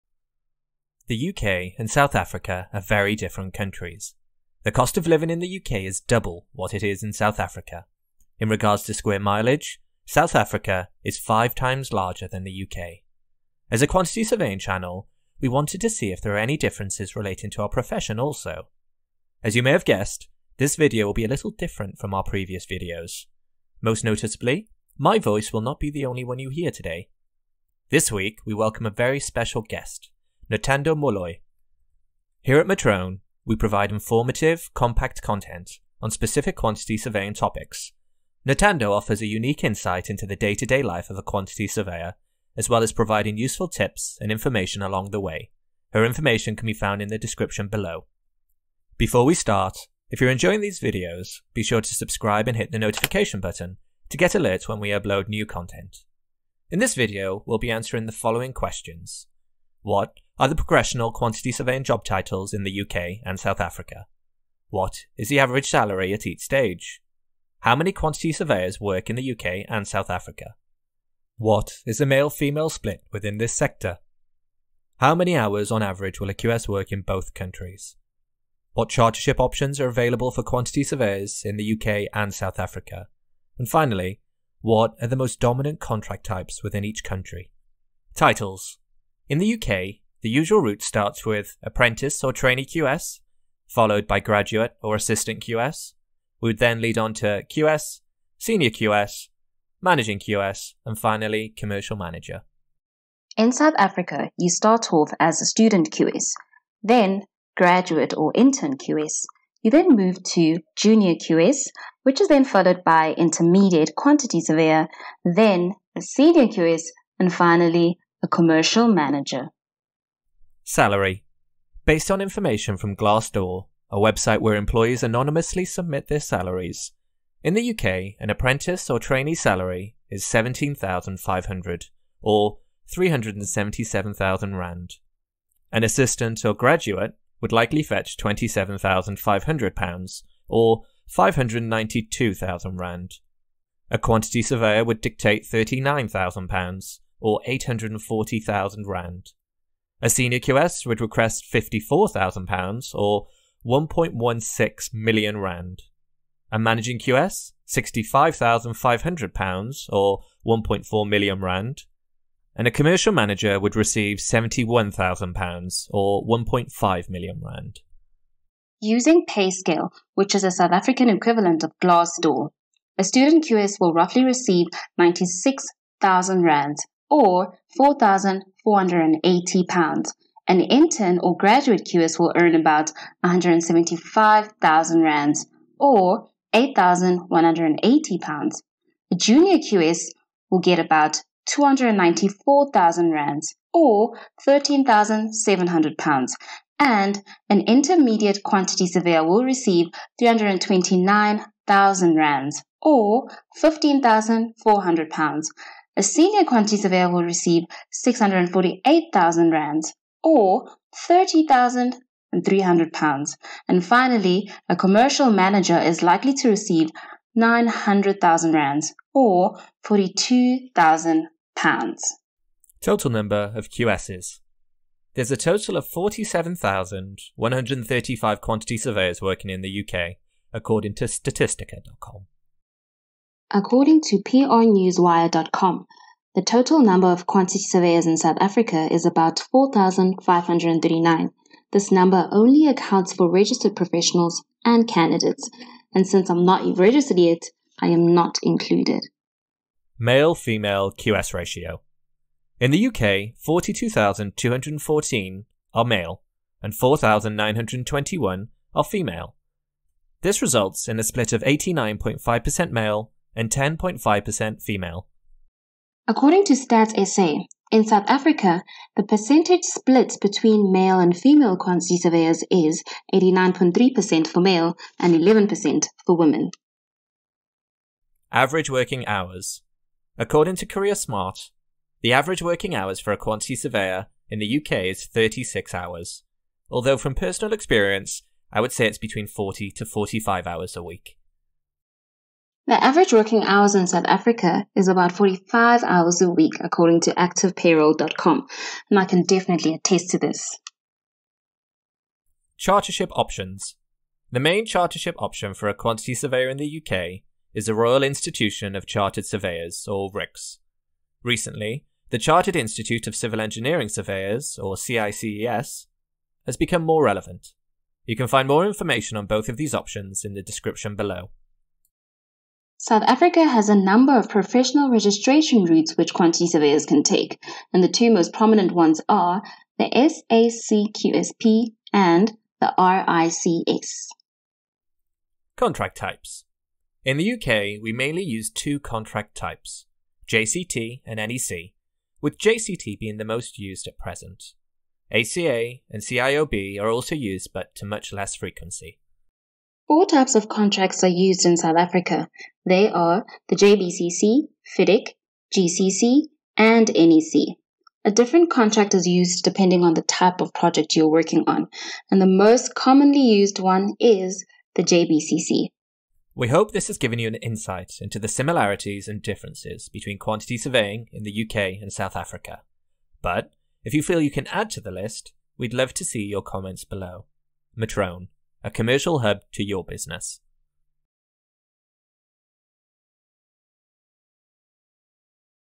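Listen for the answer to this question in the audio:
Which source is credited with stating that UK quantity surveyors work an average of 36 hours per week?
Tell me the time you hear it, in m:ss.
4:40.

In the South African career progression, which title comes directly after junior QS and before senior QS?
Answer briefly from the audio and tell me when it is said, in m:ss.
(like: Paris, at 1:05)
Intermediate quantity surveyor, at 1:53.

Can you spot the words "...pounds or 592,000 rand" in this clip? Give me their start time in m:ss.
2:19.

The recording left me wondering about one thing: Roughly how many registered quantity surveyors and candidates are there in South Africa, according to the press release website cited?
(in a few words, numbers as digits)
4,539.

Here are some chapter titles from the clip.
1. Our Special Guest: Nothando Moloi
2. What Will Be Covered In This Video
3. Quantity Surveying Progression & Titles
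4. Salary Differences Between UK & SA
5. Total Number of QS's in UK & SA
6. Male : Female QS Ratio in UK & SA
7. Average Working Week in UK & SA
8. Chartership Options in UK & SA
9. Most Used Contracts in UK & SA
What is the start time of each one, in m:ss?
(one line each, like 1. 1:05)
1. 0:24
2. 0:55
3. 1:27
4. 1:58
5. 3:42
6. 4:08
7. 4:37
8. 5:02
9. 5:35.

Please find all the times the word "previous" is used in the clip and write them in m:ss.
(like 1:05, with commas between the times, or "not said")
0:22.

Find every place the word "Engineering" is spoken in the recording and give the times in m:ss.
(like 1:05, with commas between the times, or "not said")
5:13.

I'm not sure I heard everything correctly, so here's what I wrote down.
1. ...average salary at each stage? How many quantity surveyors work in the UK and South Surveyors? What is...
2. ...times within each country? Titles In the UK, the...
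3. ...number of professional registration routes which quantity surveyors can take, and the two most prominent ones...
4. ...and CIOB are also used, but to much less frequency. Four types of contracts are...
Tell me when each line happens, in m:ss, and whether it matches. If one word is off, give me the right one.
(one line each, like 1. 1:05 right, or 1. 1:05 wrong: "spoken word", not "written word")
1. 1:05 wrong: "Africa", not "Surveyors"
2. 1:26 wrong: "types", not "times"
3. 5:23 right
4. 5:45 right.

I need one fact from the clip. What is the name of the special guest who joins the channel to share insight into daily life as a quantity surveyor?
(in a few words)
Nothando Moloi.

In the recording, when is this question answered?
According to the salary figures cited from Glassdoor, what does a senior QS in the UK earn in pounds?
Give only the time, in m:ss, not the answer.
2:31.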